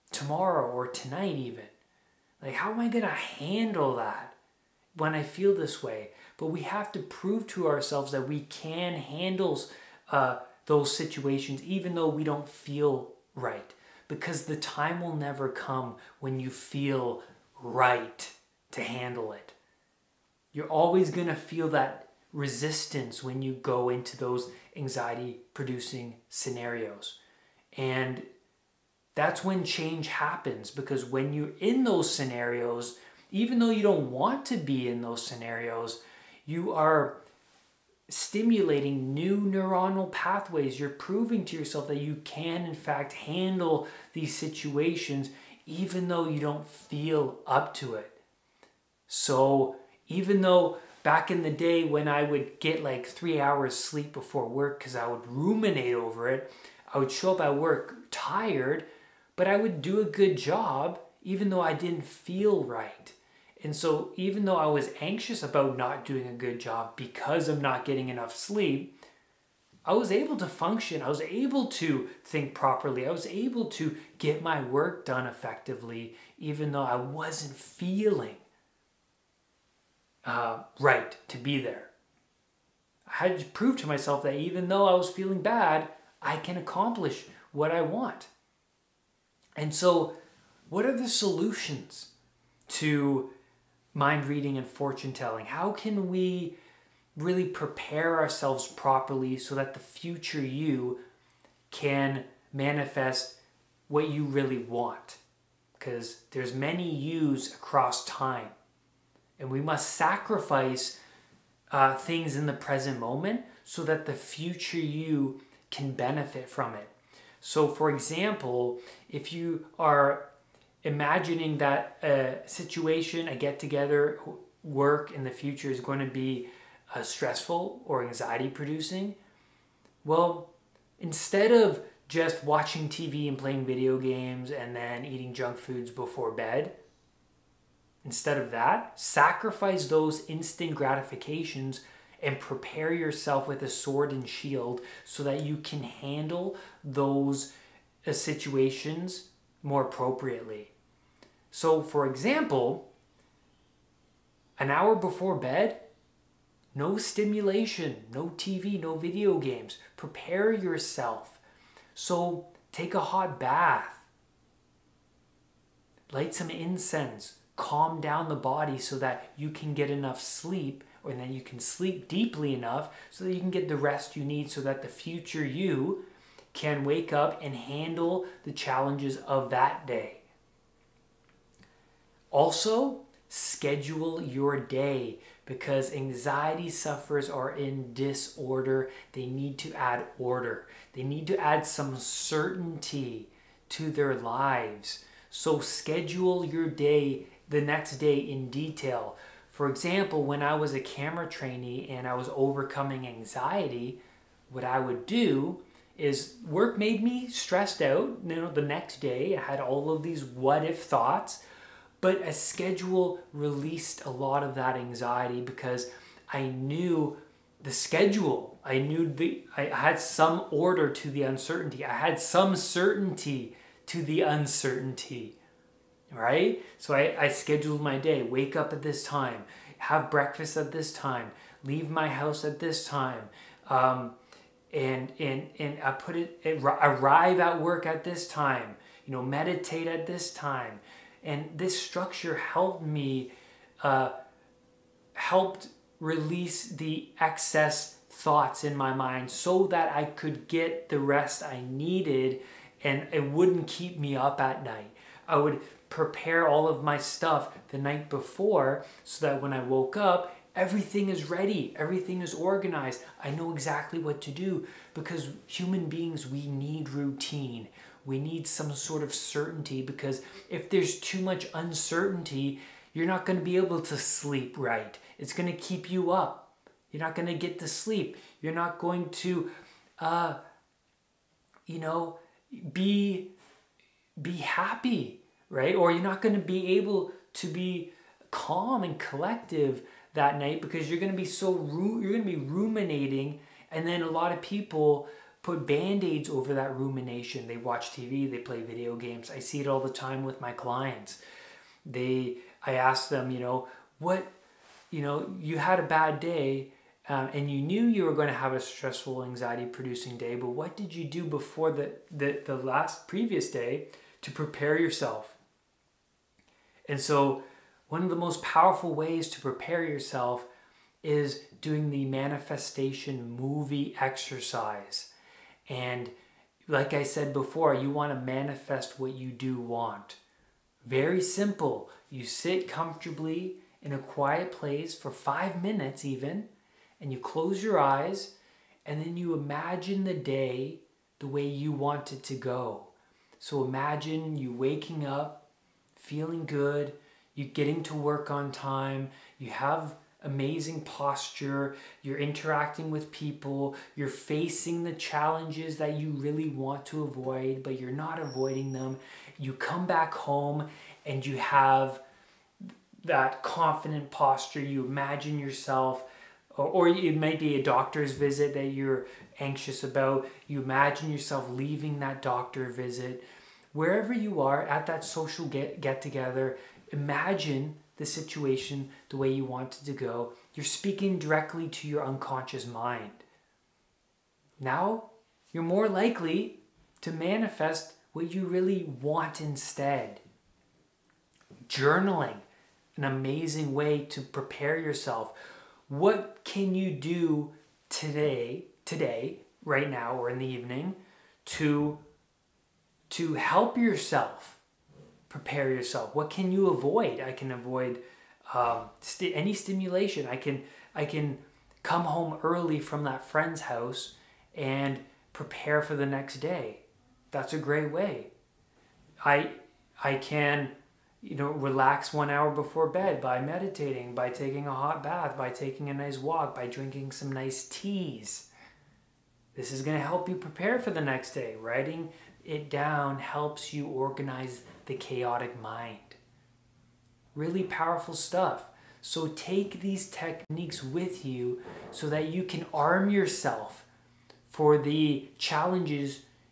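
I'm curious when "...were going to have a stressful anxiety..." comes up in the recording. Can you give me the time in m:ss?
5:08.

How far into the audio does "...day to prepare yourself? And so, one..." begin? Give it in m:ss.
5:13.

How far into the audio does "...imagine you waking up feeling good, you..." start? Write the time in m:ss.
5:43.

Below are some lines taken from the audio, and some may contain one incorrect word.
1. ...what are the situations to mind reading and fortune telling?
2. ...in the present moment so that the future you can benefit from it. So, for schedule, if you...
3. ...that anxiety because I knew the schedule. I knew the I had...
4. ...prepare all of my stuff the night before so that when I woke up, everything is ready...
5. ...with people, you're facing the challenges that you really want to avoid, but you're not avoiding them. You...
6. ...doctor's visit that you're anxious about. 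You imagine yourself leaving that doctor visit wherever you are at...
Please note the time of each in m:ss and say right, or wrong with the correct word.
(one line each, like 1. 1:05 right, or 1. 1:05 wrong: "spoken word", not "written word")
1. 1:30 wrong: "solutions", not "situations"
2. 1:52 wrong: "example", not "schedule"
3. 3:34 right
4. 4:15 right
5. 5:52 right
6. 6:07 right.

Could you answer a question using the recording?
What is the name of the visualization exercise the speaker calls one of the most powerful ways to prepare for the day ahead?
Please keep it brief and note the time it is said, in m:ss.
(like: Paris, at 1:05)
manifestation movie exercise, at 5:22.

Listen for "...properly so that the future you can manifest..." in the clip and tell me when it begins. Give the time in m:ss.
1:38.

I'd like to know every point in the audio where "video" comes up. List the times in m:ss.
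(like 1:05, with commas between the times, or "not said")
2:13, 2:38, 4:58.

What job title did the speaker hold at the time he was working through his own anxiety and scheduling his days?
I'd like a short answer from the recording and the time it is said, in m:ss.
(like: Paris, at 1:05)
camera trainee, at 3:20.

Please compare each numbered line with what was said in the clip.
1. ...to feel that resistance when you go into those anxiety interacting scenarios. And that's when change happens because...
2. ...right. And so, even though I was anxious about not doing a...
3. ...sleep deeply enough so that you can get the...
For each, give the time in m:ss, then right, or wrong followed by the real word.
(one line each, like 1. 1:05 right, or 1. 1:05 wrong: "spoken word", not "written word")
1. 0:21 wrong: "producing", not "interacting"
2. 1:02 right
3. 2:51 right.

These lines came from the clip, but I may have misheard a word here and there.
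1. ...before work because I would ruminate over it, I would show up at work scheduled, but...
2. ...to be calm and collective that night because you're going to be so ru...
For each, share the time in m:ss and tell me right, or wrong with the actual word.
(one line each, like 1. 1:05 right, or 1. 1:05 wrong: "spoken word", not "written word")
1. 0:54 wrong: "tired", not "scheduled"
2. 4:47 right.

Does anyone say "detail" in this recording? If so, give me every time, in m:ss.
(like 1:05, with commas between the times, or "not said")
3:18.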